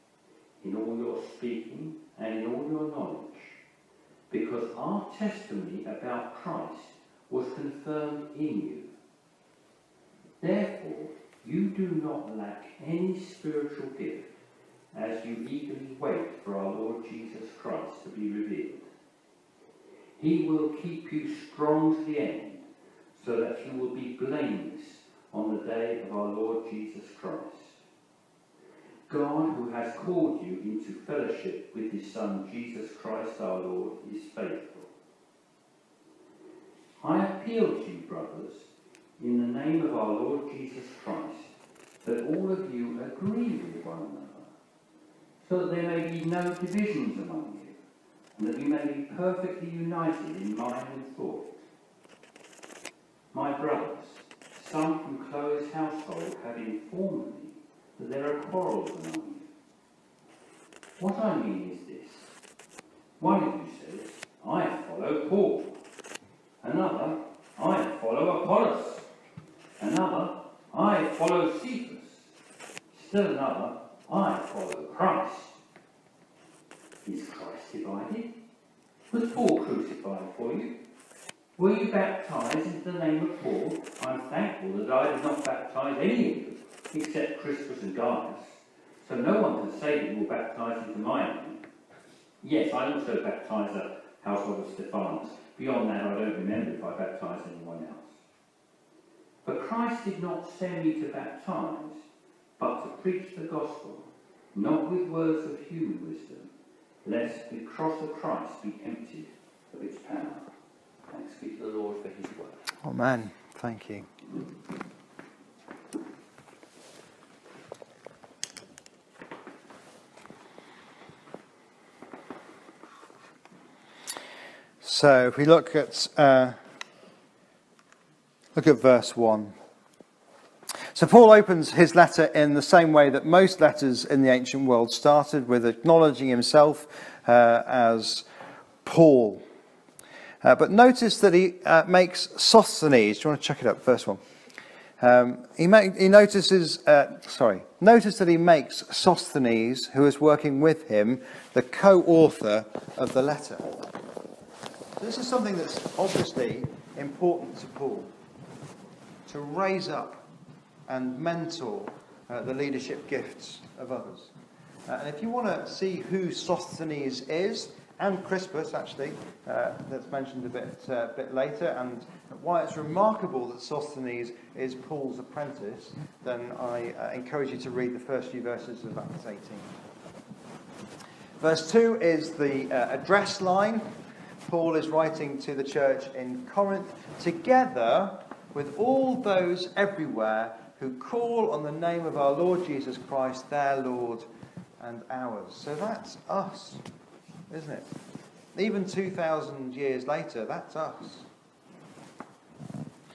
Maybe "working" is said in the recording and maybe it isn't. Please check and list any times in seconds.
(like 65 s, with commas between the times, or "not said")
150 s.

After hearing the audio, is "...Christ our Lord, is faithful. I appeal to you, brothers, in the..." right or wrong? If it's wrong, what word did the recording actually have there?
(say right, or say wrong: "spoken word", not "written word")
right.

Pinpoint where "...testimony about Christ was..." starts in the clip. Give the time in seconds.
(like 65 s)
5 s.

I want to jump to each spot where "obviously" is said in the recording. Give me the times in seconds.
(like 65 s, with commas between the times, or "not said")
155 s.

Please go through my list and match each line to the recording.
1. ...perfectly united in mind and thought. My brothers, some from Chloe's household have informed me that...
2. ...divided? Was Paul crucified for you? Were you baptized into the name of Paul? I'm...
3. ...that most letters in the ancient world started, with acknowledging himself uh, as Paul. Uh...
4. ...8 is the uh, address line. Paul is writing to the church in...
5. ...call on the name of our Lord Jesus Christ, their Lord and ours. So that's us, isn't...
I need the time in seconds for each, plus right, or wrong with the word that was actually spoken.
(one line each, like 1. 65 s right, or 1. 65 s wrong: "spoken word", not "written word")
1. 49 s right
2. 77 s right
3. 133 s right
4. 181 s wrong: "2", not "8"
5. 190 s right.